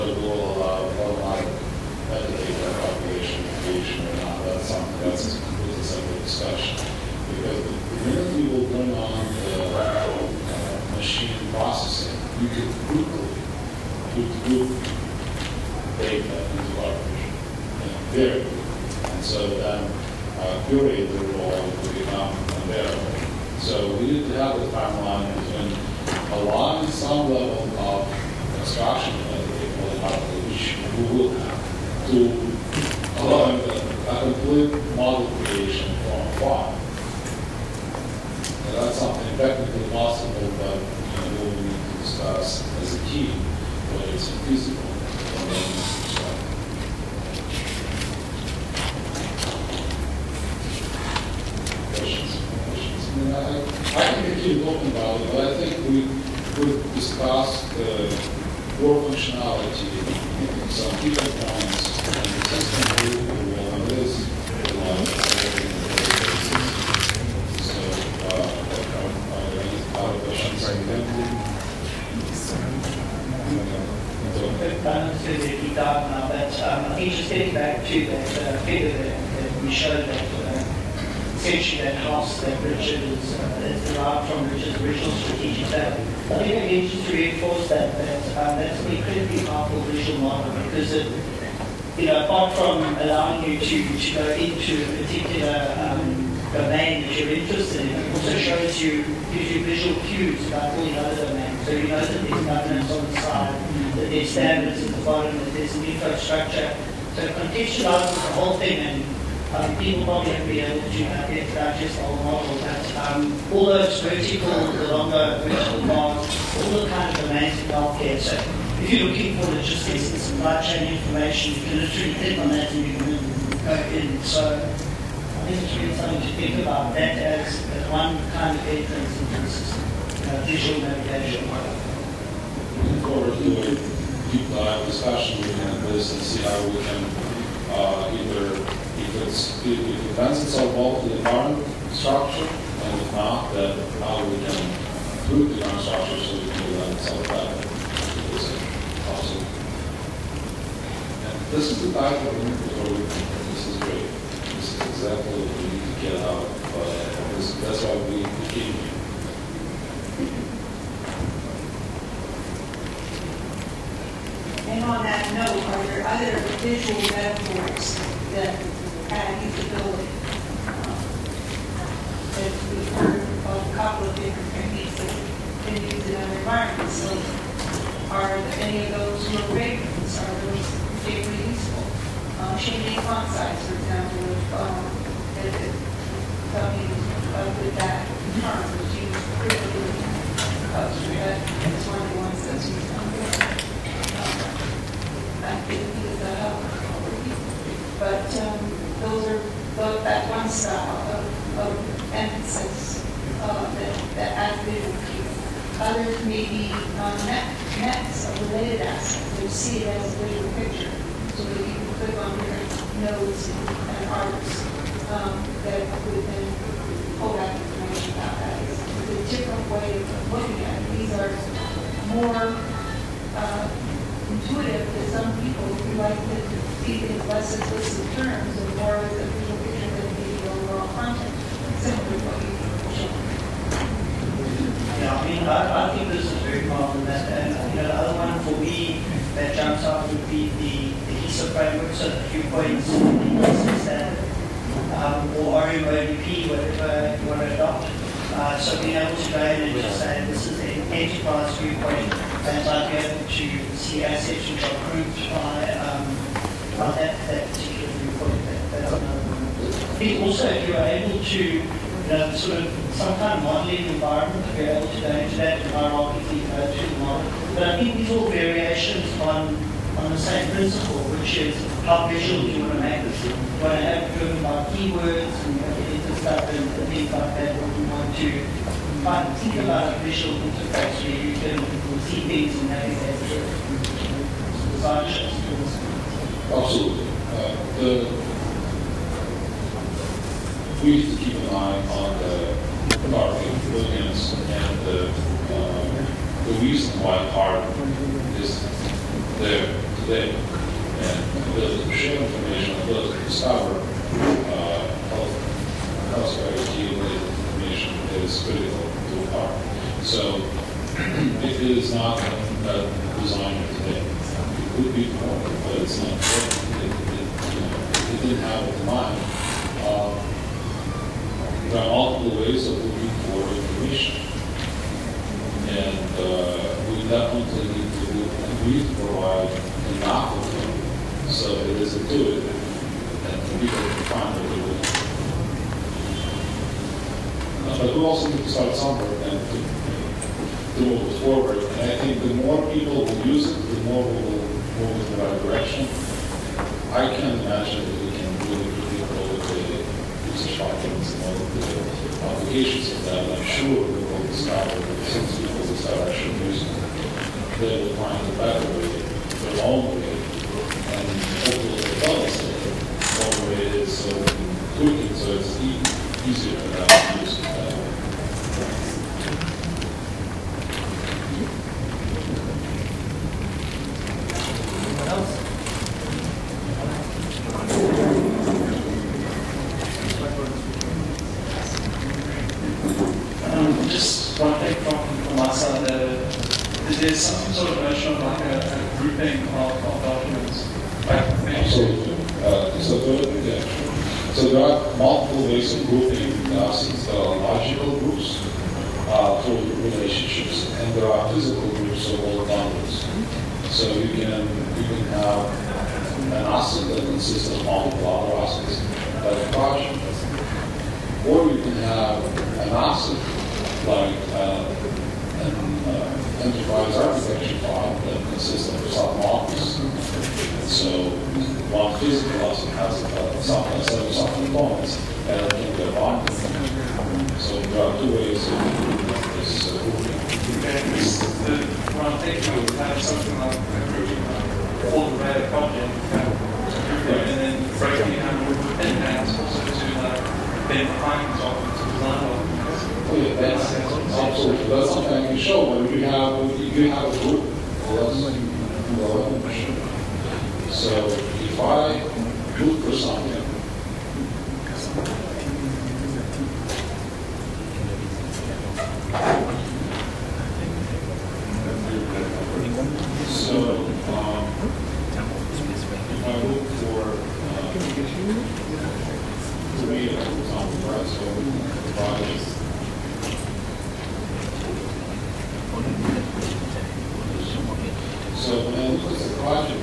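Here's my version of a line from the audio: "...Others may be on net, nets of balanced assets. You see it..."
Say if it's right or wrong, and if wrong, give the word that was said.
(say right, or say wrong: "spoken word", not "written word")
wrong: "related", not "balanced".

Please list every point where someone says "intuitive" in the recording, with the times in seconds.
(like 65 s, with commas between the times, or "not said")
224 s, 331 s.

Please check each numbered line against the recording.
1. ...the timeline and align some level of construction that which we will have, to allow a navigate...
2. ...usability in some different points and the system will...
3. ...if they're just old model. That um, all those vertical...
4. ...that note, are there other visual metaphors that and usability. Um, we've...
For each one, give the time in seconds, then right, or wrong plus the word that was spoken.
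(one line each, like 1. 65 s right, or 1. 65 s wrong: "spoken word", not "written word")
1. 24 s wrong: "complete", not "navigate"
2. 59 s wrong: "functionality", not "usability"
3. 111 s right
4. 165 s right.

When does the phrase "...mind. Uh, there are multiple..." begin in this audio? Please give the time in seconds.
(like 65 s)
318 s.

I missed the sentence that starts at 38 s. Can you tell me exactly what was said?
That's something technically possible, but you know, we need to discuss as a key, whether it's feasible.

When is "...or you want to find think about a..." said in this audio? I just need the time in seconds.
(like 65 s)
277 s.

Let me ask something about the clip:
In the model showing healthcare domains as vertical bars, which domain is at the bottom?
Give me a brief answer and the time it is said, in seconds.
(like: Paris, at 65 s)
standards, at 104 s.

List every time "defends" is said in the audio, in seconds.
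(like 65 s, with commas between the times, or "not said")
140 s, 146 s.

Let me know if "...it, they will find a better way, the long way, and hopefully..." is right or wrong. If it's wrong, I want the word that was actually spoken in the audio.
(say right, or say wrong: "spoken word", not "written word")
right.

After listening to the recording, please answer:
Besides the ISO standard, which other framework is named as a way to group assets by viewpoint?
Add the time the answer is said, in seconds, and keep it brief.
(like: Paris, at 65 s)
RM-ODP, at 245 s.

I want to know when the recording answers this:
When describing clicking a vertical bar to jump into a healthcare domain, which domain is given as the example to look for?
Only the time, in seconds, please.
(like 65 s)
119 s.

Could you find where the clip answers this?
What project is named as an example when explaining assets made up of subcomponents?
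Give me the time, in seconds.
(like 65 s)
434 s.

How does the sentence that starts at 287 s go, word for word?
Uh, the, we need to keep an eye on the market millions and the, uh, the reason why art is there today.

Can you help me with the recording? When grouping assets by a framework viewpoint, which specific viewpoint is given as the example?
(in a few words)
enterprise viewpoint.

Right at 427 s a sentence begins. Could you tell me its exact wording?
So there are two ways of doing this.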